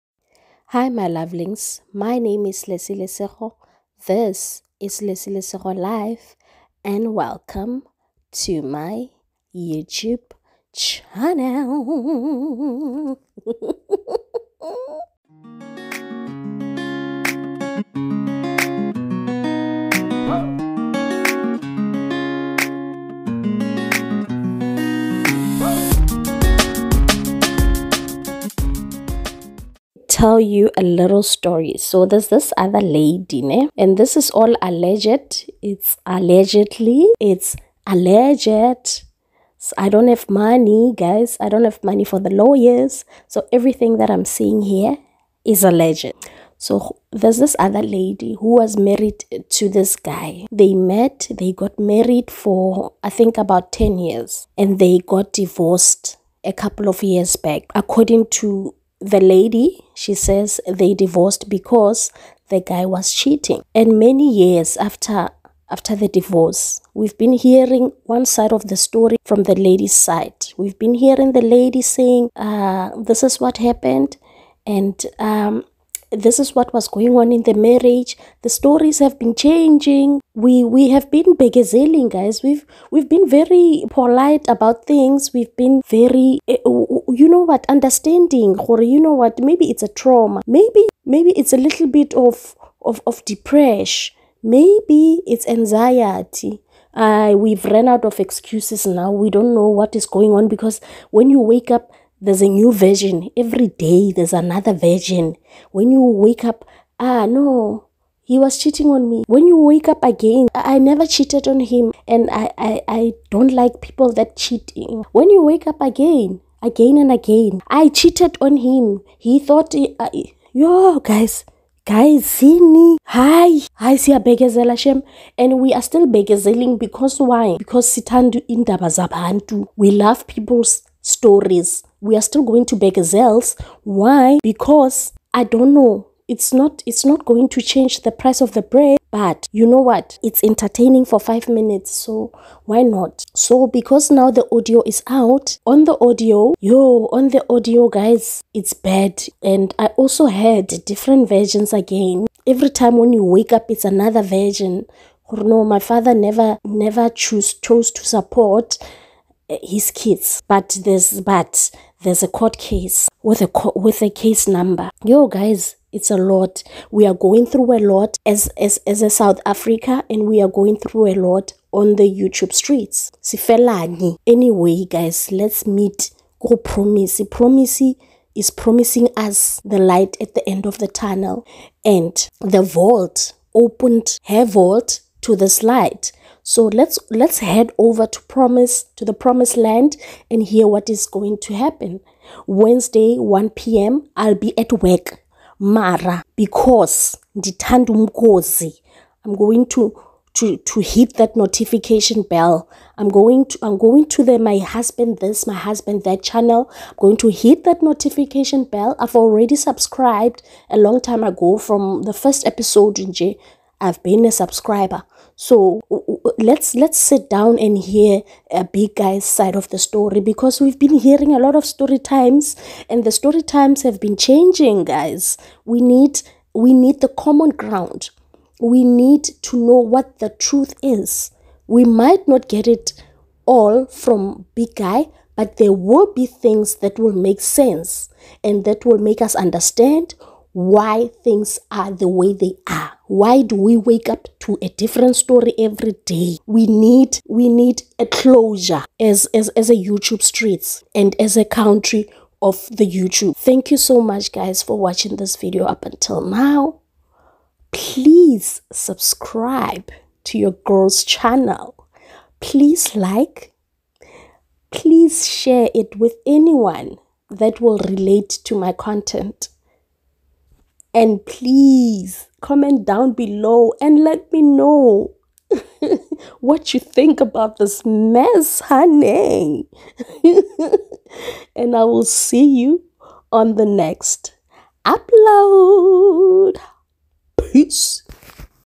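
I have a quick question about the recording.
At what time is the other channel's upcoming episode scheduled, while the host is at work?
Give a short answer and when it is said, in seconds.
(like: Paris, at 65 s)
1 p.m., at 193 s.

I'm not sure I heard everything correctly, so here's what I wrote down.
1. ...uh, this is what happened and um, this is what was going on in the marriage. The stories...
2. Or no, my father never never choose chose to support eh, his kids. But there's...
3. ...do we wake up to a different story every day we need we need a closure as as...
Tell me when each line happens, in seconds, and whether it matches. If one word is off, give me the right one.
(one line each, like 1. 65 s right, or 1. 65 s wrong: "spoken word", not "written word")
1. 72 s right
2. 155 s right
3. 243 s right.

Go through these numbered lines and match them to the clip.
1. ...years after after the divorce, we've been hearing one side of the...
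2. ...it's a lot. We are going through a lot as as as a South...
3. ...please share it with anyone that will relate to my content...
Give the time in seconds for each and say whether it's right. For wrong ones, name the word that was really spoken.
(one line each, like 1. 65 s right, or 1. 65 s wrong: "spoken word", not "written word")
1. 64 s right
2. 165 s right
3. 264 s right.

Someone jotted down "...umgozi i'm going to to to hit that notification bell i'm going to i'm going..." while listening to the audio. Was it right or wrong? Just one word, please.
right.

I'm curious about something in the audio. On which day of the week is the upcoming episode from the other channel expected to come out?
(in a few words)
Wednesday.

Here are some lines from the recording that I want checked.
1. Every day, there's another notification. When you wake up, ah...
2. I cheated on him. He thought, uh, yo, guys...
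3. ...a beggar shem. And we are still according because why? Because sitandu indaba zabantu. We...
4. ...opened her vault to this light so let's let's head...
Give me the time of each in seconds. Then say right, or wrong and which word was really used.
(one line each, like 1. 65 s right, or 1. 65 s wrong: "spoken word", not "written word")
1. 103 s wrong: "version", not "notification"
2. 117 s right
3. 124 s wrong: "bekezeling", not "according"
4. 183 s right.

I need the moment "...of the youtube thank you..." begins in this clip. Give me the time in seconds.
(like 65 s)
252 s.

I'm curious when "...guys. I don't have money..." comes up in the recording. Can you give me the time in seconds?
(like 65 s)
40 s.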